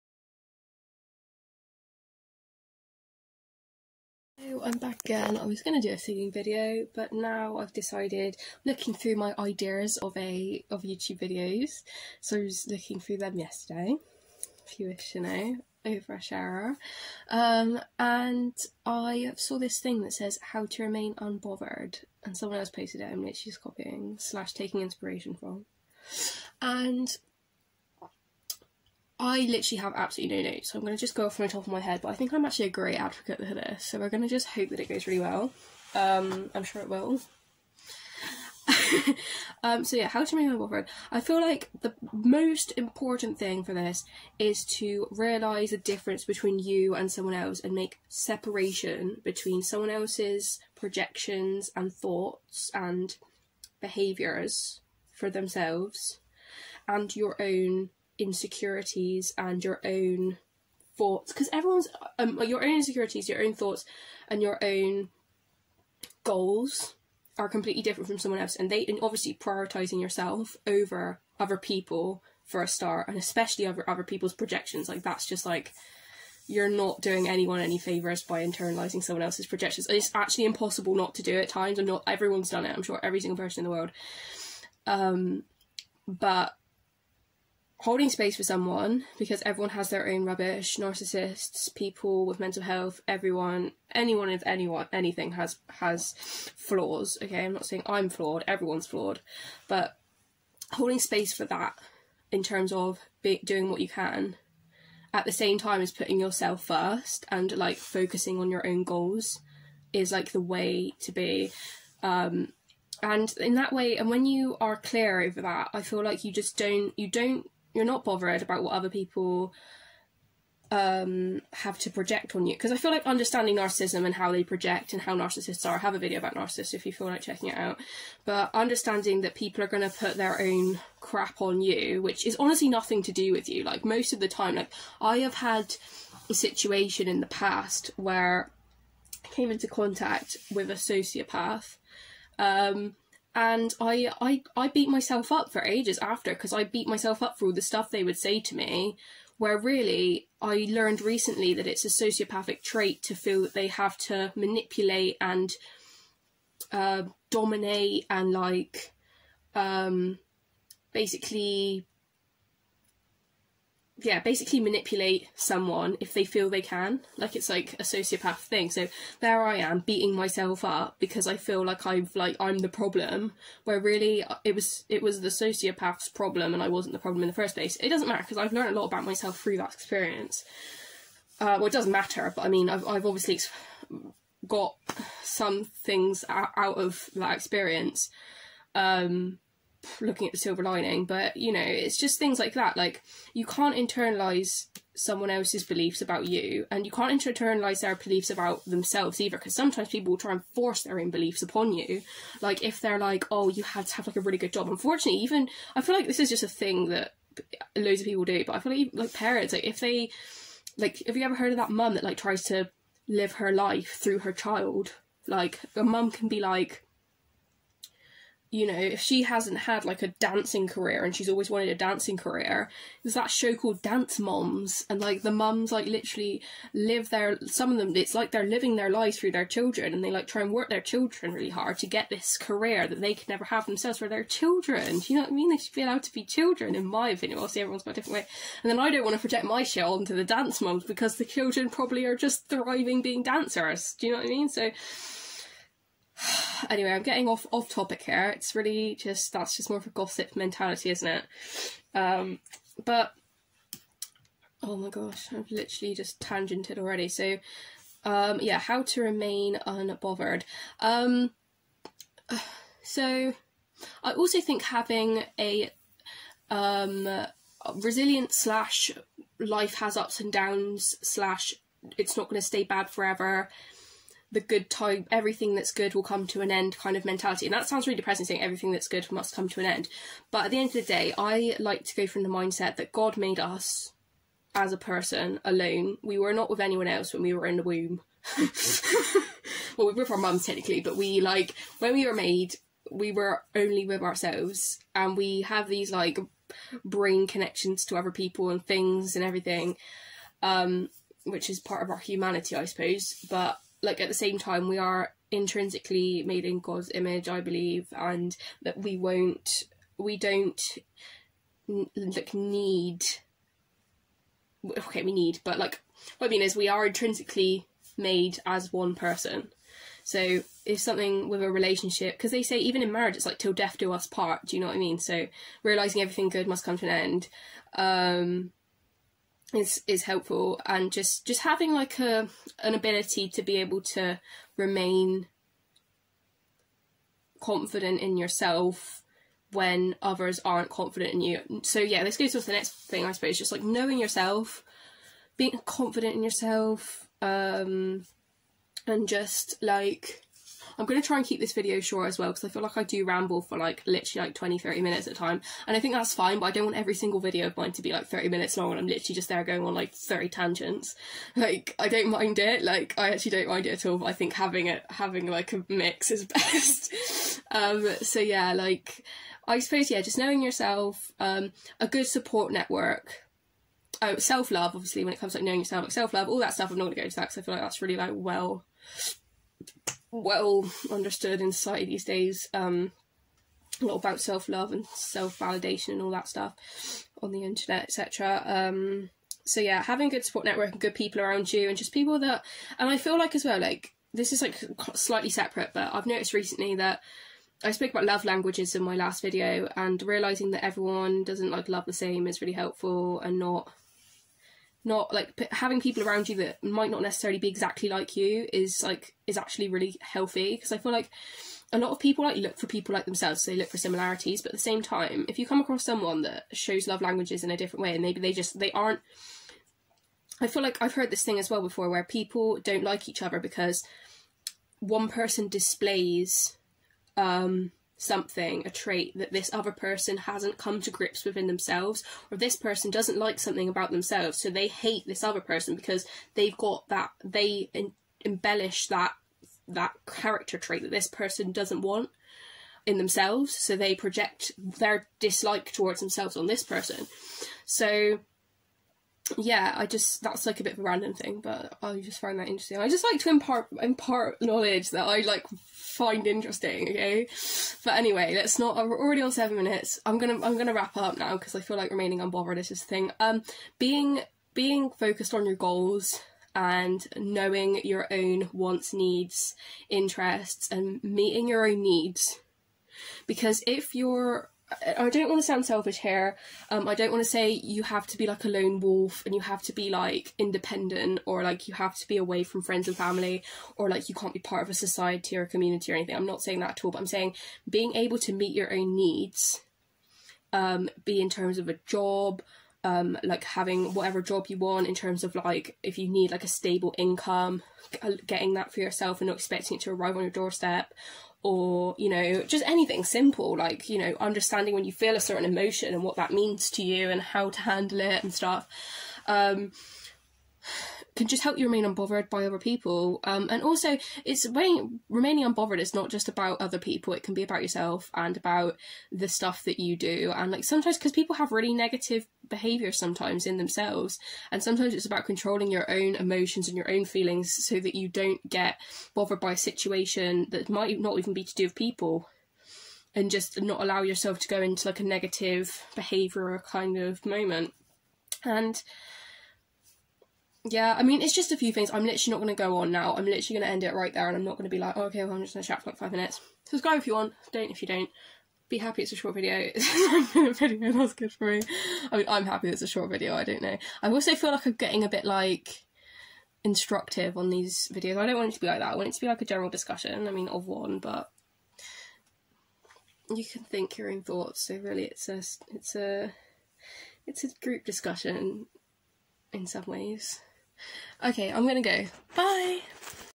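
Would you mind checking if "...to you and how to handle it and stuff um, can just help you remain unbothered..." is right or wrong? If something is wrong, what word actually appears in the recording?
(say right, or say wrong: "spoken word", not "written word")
right.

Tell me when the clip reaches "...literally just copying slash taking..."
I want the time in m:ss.
0:23.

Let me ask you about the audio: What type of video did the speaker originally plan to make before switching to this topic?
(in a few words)
singing video.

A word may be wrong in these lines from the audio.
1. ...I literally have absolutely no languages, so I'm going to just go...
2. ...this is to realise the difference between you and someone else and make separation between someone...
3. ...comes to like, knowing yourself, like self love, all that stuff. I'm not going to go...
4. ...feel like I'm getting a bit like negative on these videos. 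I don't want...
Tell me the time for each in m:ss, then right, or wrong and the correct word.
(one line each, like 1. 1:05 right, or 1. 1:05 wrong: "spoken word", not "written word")
1. 0:29 wrong: "notes", not "languages"
2. 0:43 right
3. 6:15 right
4. 9:14 wrong: "instructive", not "negative".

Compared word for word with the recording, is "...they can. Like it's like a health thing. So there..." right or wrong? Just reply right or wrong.
wrong.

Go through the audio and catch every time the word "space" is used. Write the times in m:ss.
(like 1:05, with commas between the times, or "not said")
1:28, 1:40.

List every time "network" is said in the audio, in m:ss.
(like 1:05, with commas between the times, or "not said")
6:12, 6:30.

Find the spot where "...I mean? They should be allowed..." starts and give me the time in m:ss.
3:55.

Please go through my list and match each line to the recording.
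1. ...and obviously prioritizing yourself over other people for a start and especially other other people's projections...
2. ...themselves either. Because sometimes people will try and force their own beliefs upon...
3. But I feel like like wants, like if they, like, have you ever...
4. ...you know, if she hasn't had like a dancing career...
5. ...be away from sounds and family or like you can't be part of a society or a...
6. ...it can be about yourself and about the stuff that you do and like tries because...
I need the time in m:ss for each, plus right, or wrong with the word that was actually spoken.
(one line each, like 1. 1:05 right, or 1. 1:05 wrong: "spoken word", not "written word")
1. 1:08 right
2. 3:18 right
3. 3:28 wrong: "parents", not "wants"
4. 3:38 right
5. 8:02 wrong: "friends", not "sounds"
6. 8:37 wrong: "sometimes", not "tries".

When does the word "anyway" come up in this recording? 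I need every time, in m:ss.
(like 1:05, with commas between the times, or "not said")
4:06, 7:37.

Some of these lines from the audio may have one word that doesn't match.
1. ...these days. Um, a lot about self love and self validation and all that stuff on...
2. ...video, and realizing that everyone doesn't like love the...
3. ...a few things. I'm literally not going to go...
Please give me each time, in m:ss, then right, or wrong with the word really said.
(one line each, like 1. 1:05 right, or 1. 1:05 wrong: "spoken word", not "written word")
1. 6:21 right
2. 6:39 right
3. 9:01 right.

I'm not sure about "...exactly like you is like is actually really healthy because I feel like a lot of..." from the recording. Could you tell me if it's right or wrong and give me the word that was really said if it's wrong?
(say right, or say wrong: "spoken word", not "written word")
right.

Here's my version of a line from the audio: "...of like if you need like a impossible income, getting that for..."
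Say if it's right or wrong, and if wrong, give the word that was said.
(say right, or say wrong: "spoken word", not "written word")
wrong: "stable", not "impossible".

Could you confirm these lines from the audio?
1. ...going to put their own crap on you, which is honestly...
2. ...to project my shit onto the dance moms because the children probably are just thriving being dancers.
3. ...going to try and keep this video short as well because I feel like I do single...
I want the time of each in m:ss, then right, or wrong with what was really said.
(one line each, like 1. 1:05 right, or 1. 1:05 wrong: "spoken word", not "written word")
1. 2:09 right
2. 3:59 right
3. 5:50 wrong: "ramble", not "single".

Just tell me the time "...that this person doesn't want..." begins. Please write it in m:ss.
7:20.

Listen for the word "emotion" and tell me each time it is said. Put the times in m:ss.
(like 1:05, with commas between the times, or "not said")
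8:25, 8:46.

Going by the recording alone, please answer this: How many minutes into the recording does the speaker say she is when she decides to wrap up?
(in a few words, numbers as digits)
7.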